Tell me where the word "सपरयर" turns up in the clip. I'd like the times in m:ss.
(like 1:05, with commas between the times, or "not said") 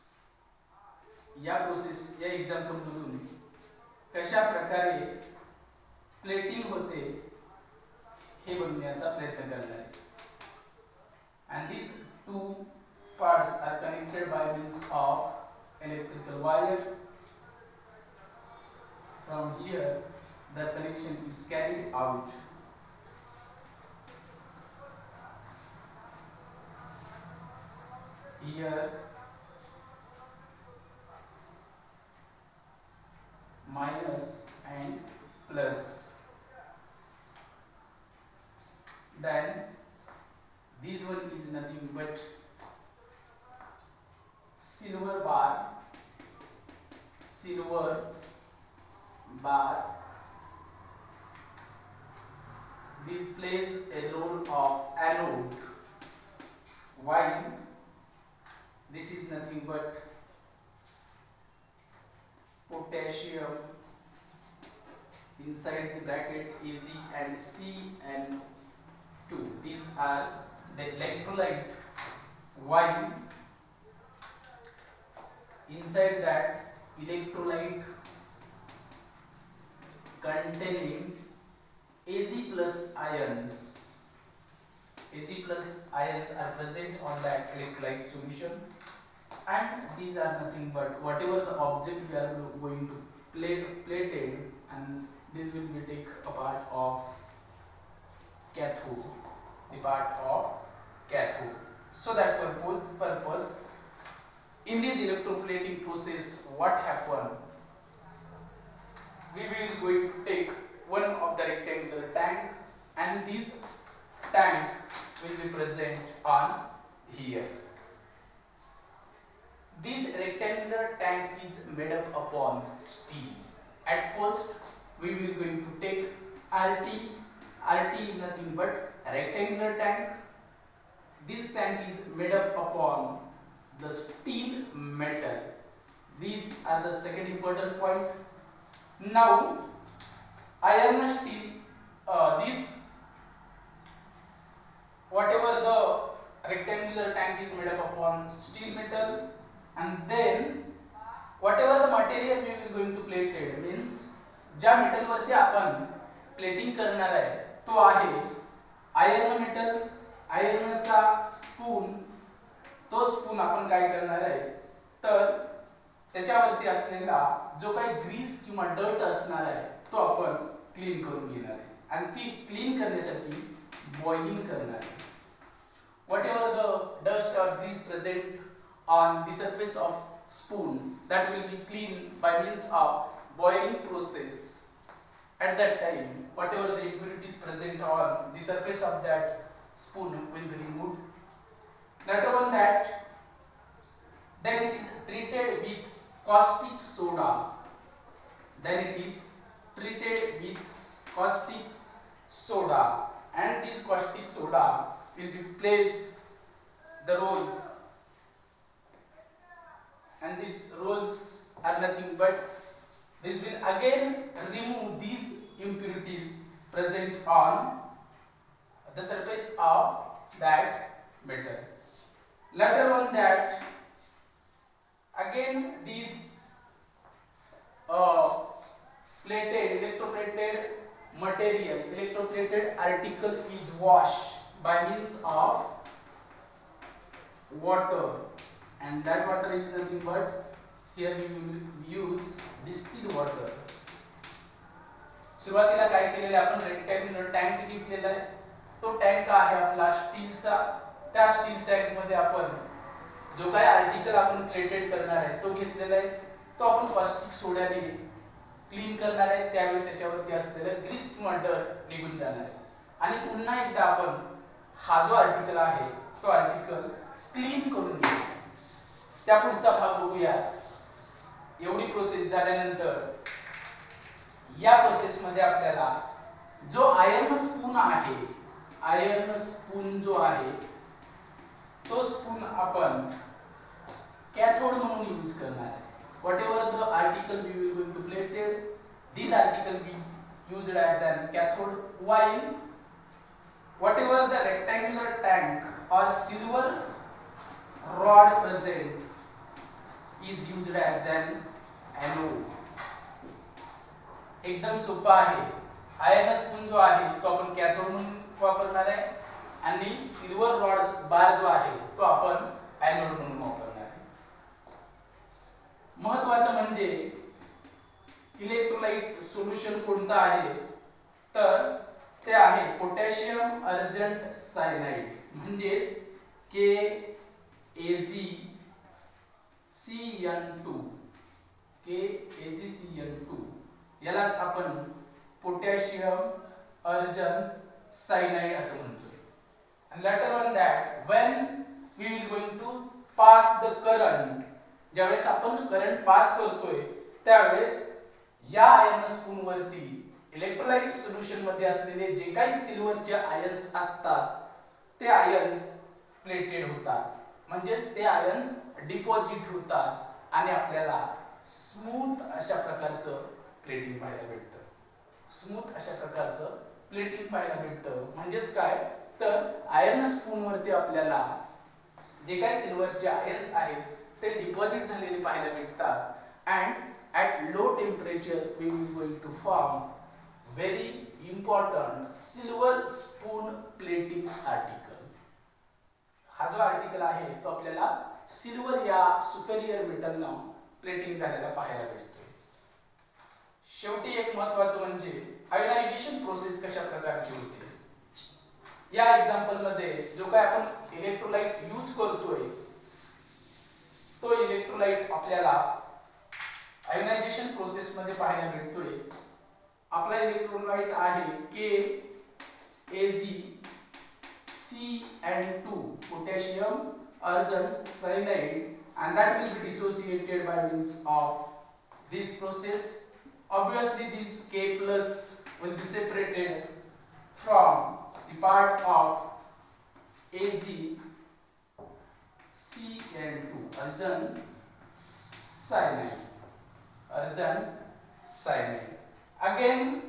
6:29.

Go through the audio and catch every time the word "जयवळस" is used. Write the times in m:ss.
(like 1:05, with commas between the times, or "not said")
5:44.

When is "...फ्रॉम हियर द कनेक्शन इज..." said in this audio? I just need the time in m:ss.
0:19.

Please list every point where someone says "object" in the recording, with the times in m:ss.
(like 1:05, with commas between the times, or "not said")
1:31.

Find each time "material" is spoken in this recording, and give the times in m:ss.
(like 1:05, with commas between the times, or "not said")
2:31, 3:51.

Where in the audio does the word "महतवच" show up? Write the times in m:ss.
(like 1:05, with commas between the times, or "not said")
5:16, 6:34.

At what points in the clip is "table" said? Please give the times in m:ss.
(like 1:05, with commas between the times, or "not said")
1:34.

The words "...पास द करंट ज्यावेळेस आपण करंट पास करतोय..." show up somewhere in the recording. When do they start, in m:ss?
5:43.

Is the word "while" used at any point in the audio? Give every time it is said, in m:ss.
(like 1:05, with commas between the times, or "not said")
0:57, 1:12.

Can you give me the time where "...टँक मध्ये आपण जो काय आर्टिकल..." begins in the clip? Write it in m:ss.
4:11.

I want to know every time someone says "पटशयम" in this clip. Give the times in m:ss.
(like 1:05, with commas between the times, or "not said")
5:22, 5:35.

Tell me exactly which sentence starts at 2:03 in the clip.
At first, we will going to take RT.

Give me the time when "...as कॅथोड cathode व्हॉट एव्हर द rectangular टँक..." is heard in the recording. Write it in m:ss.
4:50.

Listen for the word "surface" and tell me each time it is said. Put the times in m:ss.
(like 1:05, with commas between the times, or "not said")
2:59, 3:08, 3:39.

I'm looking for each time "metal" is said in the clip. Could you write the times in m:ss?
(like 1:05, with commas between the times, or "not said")
2:14, 2:28, 2:34, 2:39, 3:41.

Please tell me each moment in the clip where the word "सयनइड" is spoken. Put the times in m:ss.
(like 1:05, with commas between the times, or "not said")
5:24, 5:38.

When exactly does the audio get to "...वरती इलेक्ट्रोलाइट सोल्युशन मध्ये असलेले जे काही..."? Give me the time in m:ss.
5:49.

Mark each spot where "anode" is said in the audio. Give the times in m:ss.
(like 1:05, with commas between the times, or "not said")
0:54.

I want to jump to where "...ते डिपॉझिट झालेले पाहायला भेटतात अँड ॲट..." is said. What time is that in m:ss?
6:14.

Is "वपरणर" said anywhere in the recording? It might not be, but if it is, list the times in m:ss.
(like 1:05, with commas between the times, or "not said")
5:08, 5:13.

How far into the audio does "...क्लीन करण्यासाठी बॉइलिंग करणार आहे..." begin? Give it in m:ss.
2:52.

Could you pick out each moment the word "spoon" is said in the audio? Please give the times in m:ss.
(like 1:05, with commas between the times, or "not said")
3:00, 3:09.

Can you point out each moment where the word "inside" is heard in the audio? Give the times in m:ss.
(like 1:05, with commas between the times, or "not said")
1:05, 1:15.